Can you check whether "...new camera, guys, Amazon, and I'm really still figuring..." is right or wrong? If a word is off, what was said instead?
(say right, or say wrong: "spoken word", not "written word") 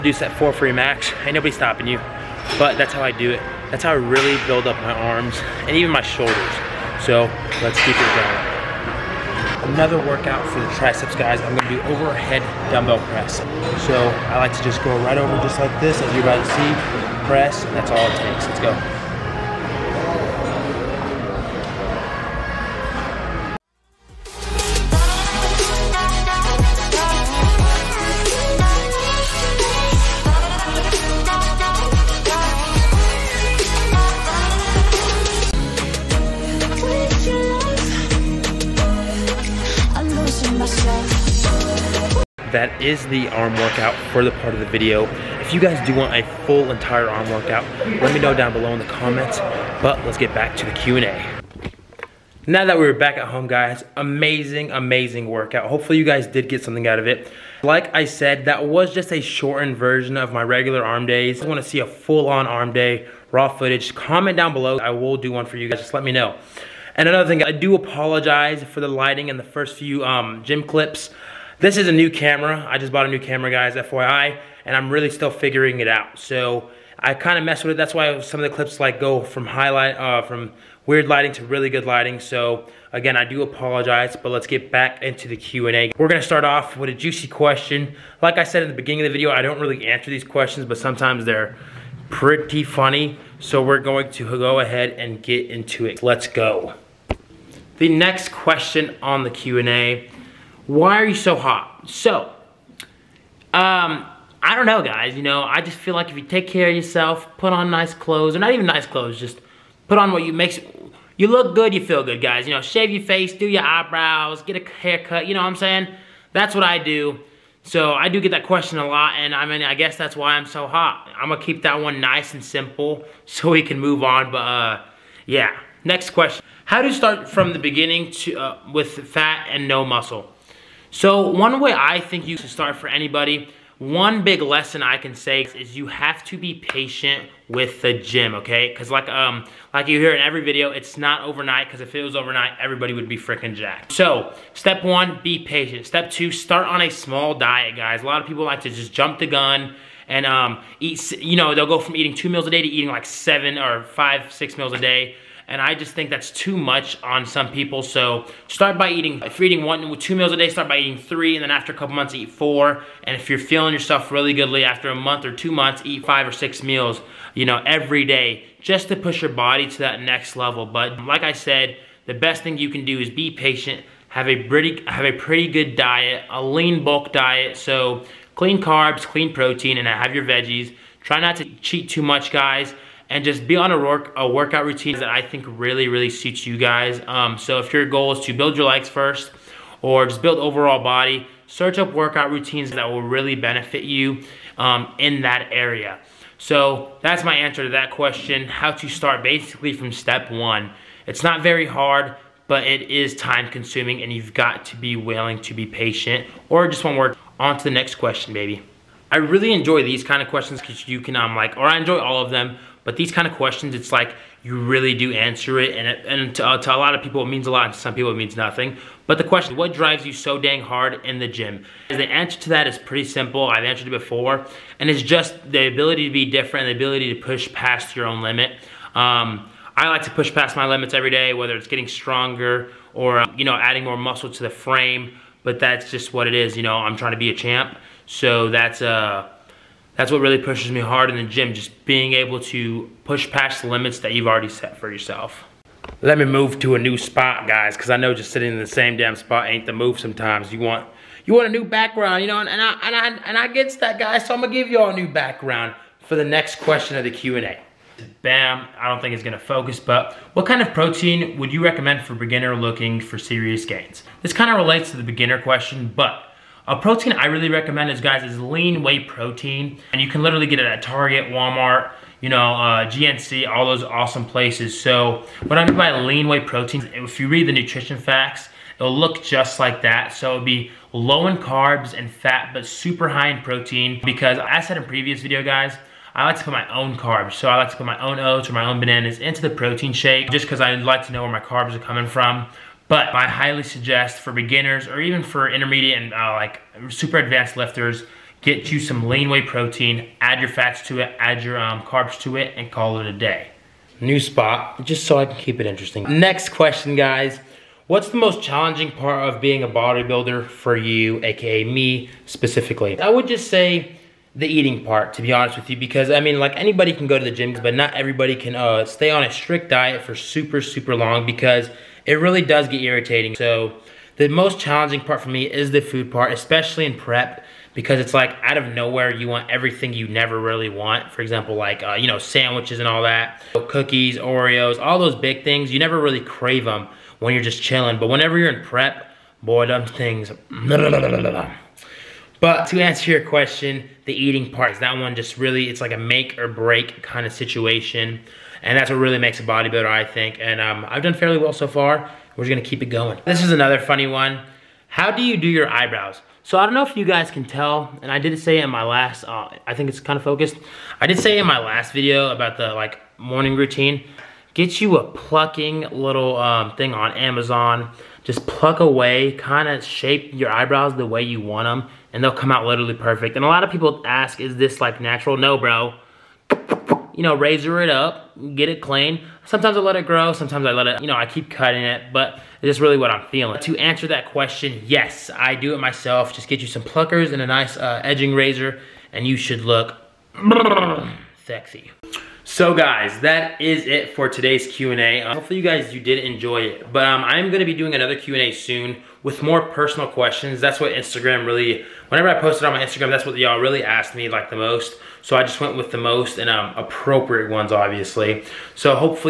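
wrong: "FYI", not "Amazon".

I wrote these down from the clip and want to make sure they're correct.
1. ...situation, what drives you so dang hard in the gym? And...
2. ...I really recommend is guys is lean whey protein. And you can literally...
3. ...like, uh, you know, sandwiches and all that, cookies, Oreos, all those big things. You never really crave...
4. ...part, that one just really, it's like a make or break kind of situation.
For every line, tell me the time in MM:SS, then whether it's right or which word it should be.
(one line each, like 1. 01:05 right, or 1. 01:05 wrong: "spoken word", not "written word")
1. 03:39 wrong: "question", not "situation"
2. 04:27 right
3. 05:31 right
4. 05:44 right.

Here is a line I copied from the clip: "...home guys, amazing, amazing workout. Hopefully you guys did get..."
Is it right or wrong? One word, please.
right.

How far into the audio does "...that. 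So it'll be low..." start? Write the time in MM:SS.
04:39.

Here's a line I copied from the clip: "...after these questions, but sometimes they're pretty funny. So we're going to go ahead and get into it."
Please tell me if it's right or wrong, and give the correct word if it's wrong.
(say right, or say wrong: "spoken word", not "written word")
wrong: "answer", not "after".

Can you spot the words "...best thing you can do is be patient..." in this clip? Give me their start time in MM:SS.
02:52.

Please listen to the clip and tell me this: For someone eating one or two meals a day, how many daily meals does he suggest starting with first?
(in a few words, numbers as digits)
3.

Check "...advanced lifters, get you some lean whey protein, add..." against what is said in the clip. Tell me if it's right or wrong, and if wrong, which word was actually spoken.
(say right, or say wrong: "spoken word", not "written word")
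right.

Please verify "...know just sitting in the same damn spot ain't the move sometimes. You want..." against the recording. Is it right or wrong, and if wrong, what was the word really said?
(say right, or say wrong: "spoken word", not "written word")
right.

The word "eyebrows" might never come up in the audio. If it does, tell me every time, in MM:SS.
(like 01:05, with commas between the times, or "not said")
01:53, 05:55, 06:10.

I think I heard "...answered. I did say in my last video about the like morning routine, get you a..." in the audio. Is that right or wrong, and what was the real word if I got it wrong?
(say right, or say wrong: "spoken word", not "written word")
wrong: "focused", not "answered".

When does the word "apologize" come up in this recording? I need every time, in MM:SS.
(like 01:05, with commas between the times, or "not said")
01:07, 01:23.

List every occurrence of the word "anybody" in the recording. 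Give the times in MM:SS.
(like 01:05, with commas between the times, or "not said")
02:12, 05:16.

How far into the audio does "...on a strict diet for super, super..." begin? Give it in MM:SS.
05:19.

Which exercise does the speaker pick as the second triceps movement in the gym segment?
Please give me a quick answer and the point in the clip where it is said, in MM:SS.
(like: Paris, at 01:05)
overhead dumbbell press, at 00:11.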